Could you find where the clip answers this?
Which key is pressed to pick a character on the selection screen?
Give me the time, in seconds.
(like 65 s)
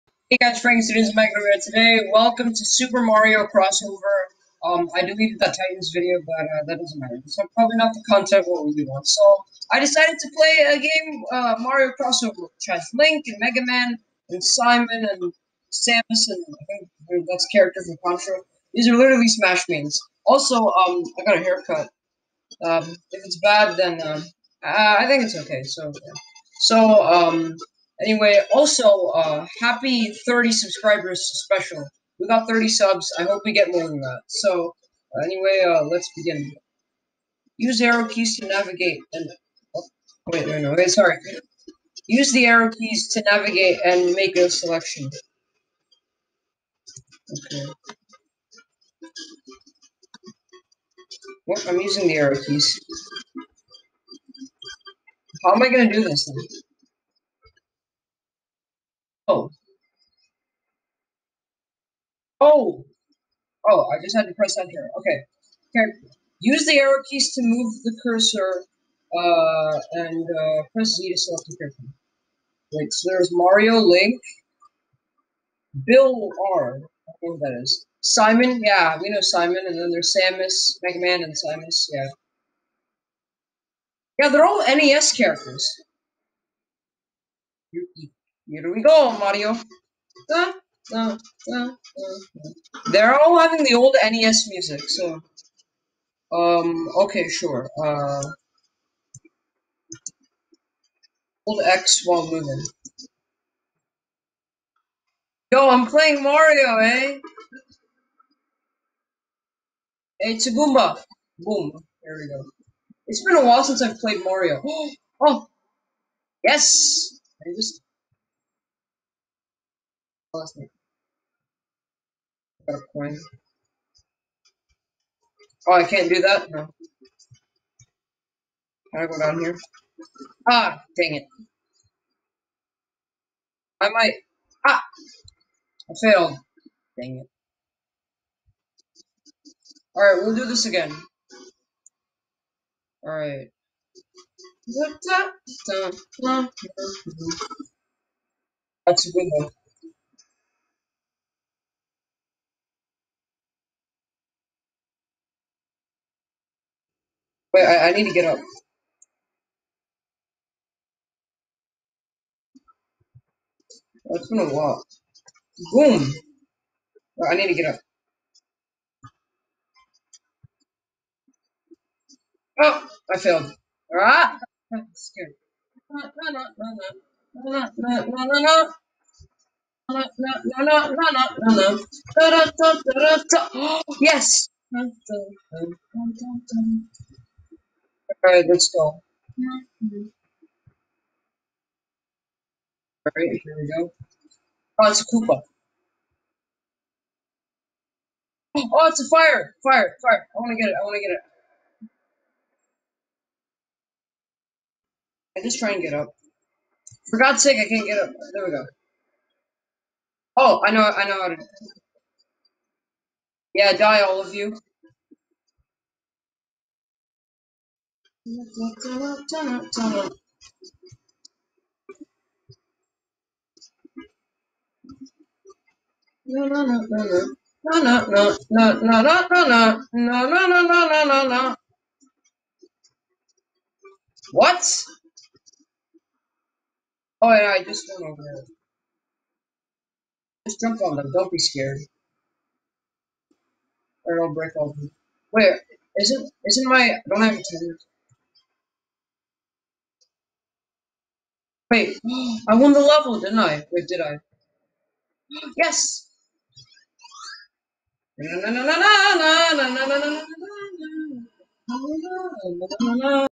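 70 s.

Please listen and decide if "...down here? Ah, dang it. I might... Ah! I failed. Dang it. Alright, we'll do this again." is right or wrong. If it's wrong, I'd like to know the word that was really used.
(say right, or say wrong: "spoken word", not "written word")
right.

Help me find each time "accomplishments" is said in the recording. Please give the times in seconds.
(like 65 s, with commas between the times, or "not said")
not said.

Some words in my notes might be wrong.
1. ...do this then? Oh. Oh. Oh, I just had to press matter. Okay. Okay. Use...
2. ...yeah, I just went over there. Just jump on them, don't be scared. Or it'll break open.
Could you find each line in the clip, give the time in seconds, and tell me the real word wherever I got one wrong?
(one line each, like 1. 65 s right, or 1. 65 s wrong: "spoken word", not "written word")
1. 55 s wrong: "enter", not "matter"
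2. 237 s right.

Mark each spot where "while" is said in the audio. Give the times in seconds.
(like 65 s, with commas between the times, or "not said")
102 s, 113 s, 164 s.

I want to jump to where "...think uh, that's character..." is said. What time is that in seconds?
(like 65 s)
16 s.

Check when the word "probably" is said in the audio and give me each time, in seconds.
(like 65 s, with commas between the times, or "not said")
7 s.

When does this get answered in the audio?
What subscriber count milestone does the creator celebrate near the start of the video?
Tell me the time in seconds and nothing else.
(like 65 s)
32 s.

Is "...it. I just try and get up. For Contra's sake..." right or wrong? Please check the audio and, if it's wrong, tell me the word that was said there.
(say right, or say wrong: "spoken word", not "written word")
wrong: "God", not "Contra".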